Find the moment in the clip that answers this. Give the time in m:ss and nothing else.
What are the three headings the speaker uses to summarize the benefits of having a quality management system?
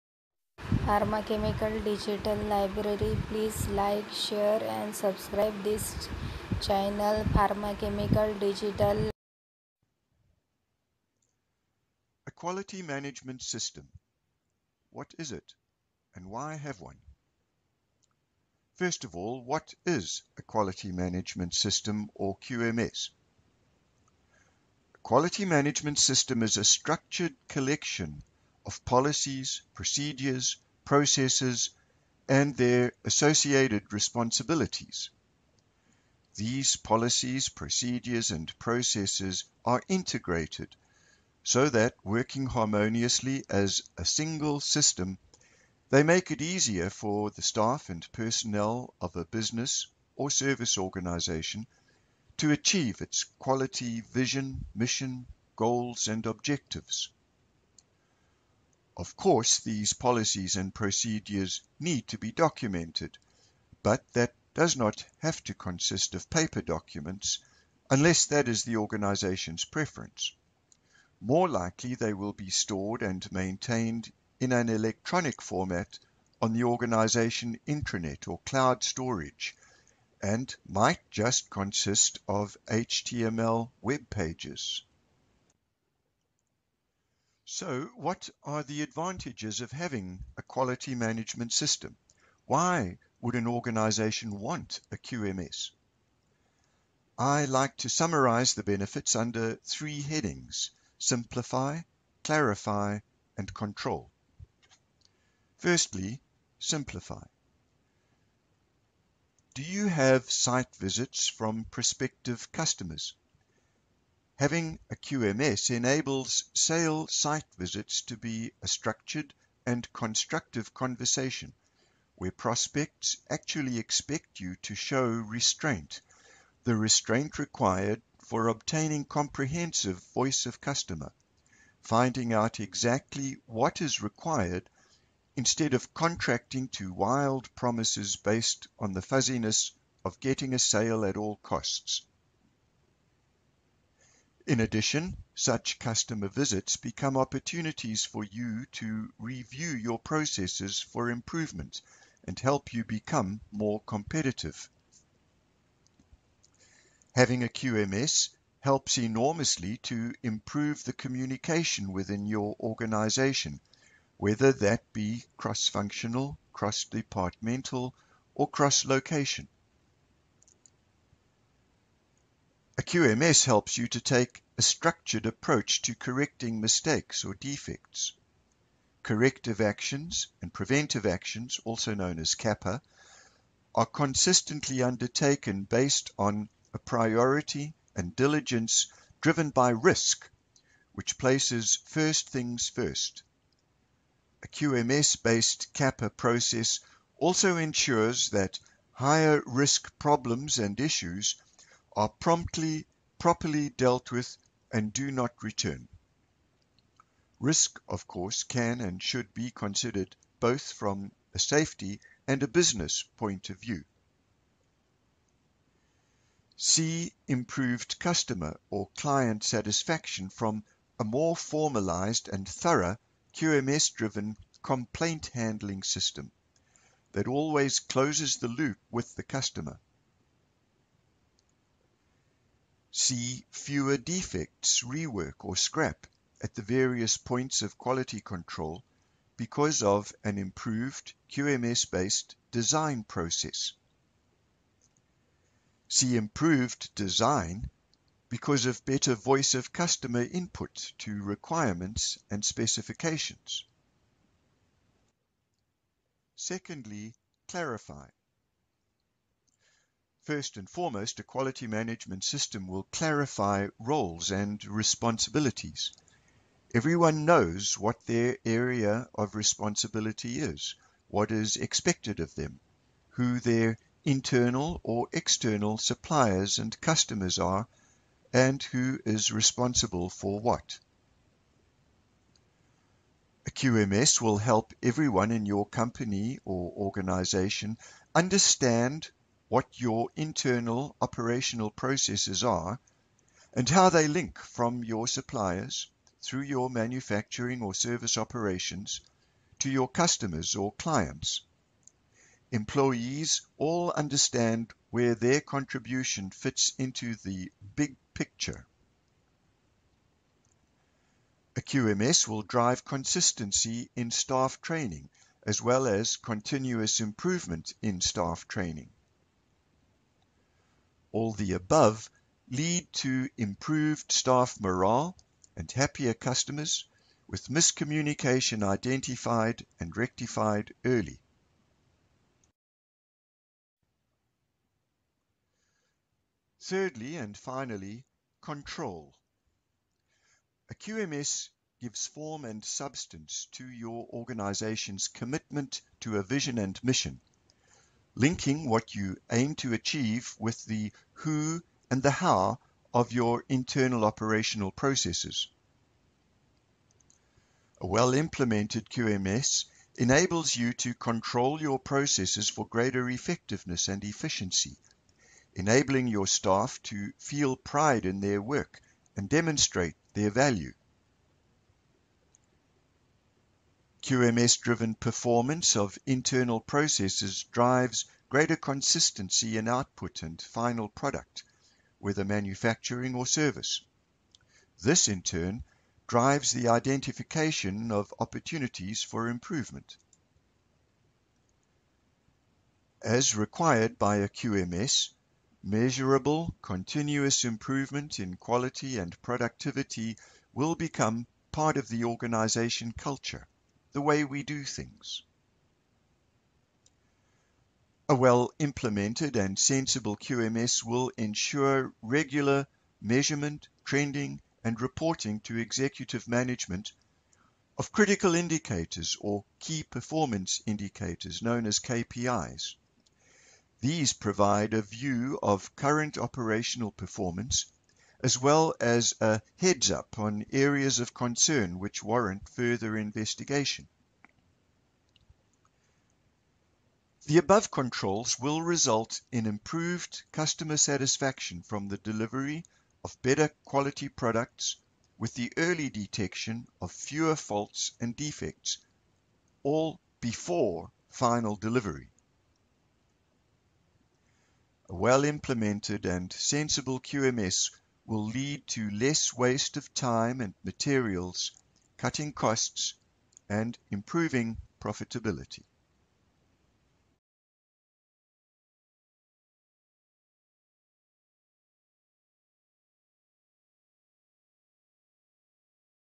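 1:40.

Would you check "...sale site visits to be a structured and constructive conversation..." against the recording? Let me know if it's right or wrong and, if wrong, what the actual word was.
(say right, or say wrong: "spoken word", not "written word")
right.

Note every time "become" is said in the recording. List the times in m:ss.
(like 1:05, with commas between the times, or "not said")
2:26, 2:32, 6:40.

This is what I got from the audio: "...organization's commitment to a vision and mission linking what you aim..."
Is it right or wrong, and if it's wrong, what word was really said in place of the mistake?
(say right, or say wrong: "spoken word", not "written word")
right.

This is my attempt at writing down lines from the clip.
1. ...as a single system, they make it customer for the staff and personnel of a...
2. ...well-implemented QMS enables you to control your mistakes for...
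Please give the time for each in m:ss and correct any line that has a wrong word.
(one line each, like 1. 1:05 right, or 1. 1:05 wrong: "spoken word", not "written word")
1. 0:43 wrong: "easier", not "customer"
2. 5:57 wrong: "processes", not "mistakes".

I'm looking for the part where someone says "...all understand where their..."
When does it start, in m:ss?
5:03.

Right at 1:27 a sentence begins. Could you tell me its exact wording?
So what are the advantages of having a quality management system?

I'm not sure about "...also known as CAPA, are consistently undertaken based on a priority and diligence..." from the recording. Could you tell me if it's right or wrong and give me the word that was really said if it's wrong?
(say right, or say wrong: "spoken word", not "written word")
right.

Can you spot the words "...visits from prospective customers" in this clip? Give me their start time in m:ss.
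1:50.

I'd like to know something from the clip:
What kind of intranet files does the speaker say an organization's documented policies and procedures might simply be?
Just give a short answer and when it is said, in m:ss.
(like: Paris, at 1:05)
HTML web pages, at 1:22.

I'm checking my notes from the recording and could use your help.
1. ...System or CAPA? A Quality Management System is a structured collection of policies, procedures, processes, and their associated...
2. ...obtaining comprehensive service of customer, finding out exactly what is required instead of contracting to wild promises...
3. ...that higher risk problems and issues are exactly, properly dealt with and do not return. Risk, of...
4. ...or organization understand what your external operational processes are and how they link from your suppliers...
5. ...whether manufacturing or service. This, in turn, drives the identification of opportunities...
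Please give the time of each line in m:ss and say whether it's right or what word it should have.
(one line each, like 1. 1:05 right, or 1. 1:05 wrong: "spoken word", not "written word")
1. 0:21 wrong: "QMS", not "CAPA"
2. 2:08 wrong: "voice", not "service"
3. 3:18 wrong: "promptly", not "exactly"
4. 4:46 wrong: "internal", not "external"
5. 6:21 right.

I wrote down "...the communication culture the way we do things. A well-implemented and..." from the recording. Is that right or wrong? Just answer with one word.
wrong.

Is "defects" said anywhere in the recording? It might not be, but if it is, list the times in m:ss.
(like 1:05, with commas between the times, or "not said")
2:57, 3:53, 7:28.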